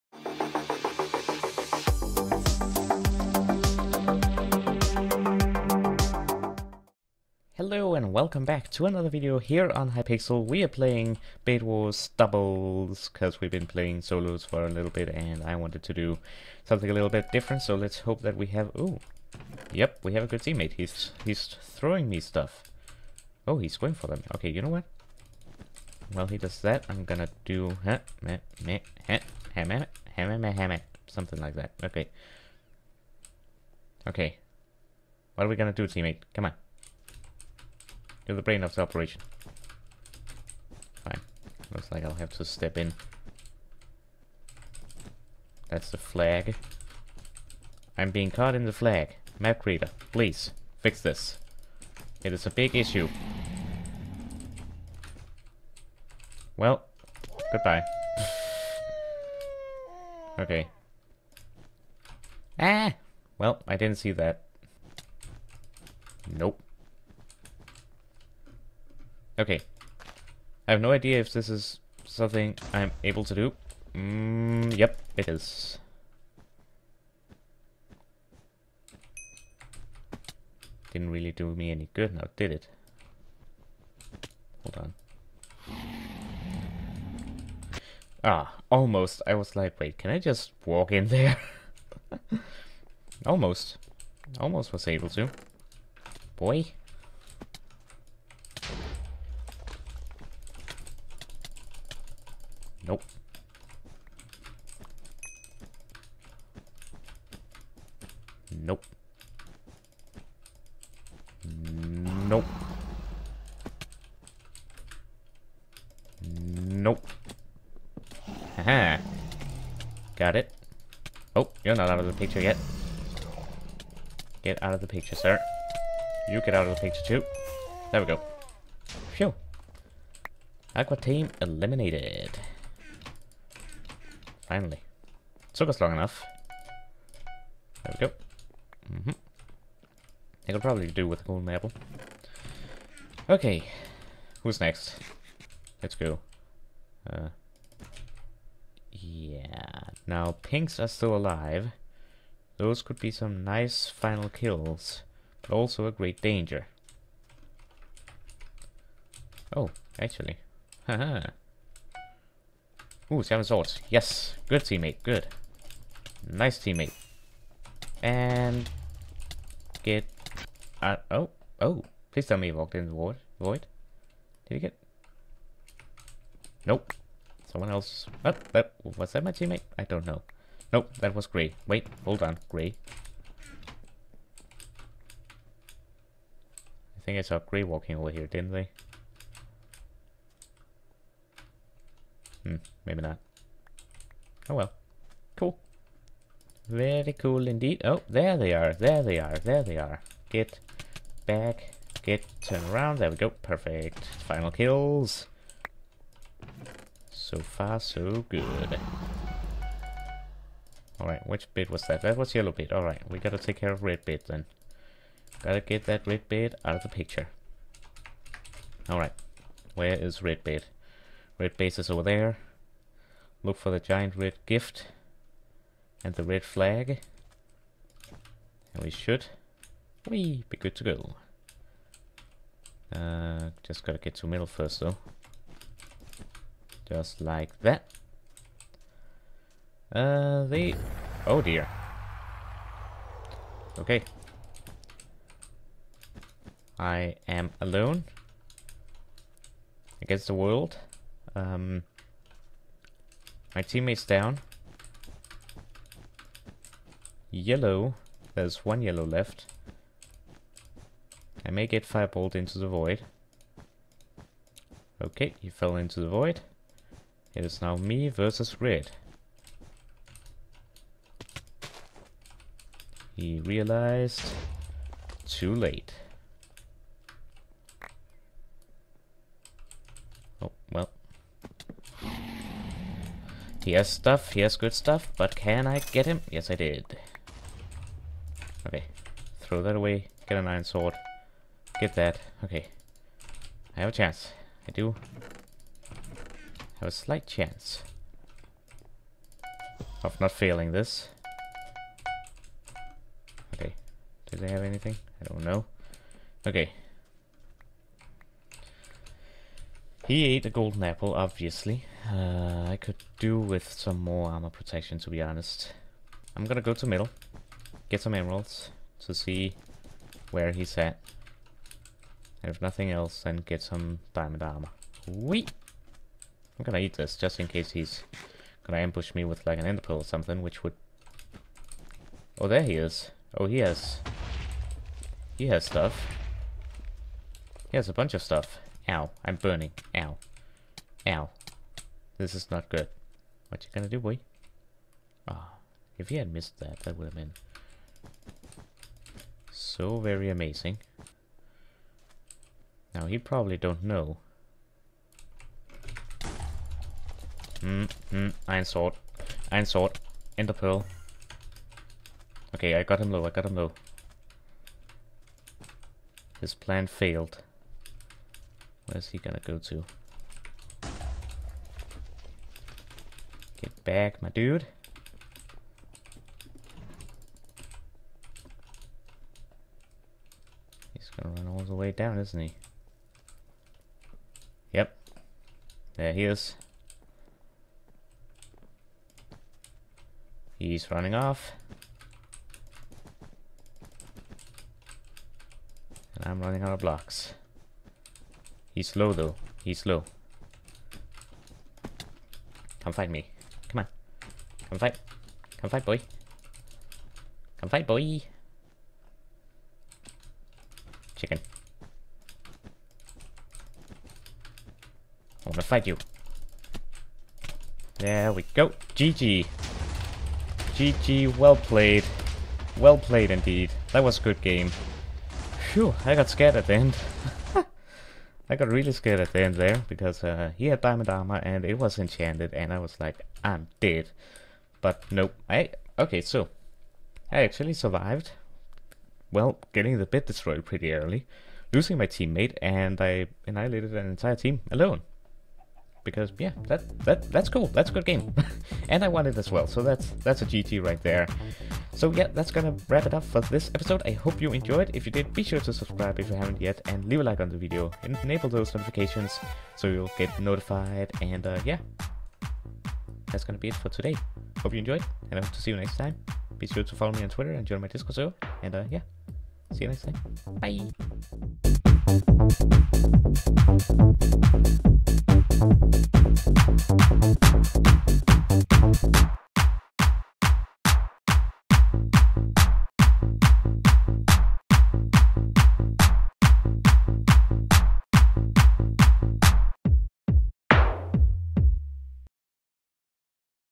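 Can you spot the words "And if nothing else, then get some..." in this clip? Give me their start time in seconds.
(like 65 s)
322 s.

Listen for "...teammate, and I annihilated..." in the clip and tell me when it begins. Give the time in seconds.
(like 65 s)
442 s.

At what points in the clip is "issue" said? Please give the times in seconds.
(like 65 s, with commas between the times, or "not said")
52 s.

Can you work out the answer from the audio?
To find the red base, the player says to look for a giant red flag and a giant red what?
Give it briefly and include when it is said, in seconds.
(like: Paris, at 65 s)
gift, at 224 s.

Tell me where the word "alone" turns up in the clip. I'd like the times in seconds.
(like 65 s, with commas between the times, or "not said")
247 s, 444 s.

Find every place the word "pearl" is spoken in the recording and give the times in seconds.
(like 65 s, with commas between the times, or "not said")
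329 s, 360 s.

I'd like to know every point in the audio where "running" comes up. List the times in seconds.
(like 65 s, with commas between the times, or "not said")
390 s, 396 s.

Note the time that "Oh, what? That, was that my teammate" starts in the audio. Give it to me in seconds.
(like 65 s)
178 s.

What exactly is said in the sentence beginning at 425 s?
Phew, I got scared at the end.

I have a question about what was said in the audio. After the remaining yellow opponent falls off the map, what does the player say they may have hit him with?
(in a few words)
firebolt.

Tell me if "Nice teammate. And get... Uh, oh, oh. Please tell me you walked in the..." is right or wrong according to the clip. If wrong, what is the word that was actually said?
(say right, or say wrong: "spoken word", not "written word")
right.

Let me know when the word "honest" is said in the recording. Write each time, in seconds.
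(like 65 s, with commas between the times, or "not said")
315 s.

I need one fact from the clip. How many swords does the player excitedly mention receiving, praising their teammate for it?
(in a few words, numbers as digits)
7.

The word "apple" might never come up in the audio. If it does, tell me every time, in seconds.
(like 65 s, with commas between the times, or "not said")
141 s, 310 s.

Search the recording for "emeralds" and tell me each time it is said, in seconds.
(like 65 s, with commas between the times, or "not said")
318 s.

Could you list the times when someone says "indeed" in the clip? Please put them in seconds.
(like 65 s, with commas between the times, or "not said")
197 s, 423 s.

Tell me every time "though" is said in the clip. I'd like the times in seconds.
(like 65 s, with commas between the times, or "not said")
234 s, 399 s.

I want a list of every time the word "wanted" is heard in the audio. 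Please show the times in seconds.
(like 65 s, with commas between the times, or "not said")
15 s.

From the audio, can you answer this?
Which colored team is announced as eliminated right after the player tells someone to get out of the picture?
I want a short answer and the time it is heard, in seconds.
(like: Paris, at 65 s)
Aqua, at 130 s.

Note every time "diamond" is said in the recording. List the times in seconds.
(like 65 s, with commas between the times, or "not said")
324 s, 430 s.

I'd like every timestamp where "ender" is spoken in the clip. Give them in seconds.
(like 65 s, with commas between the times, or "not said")
329 s, 360 s.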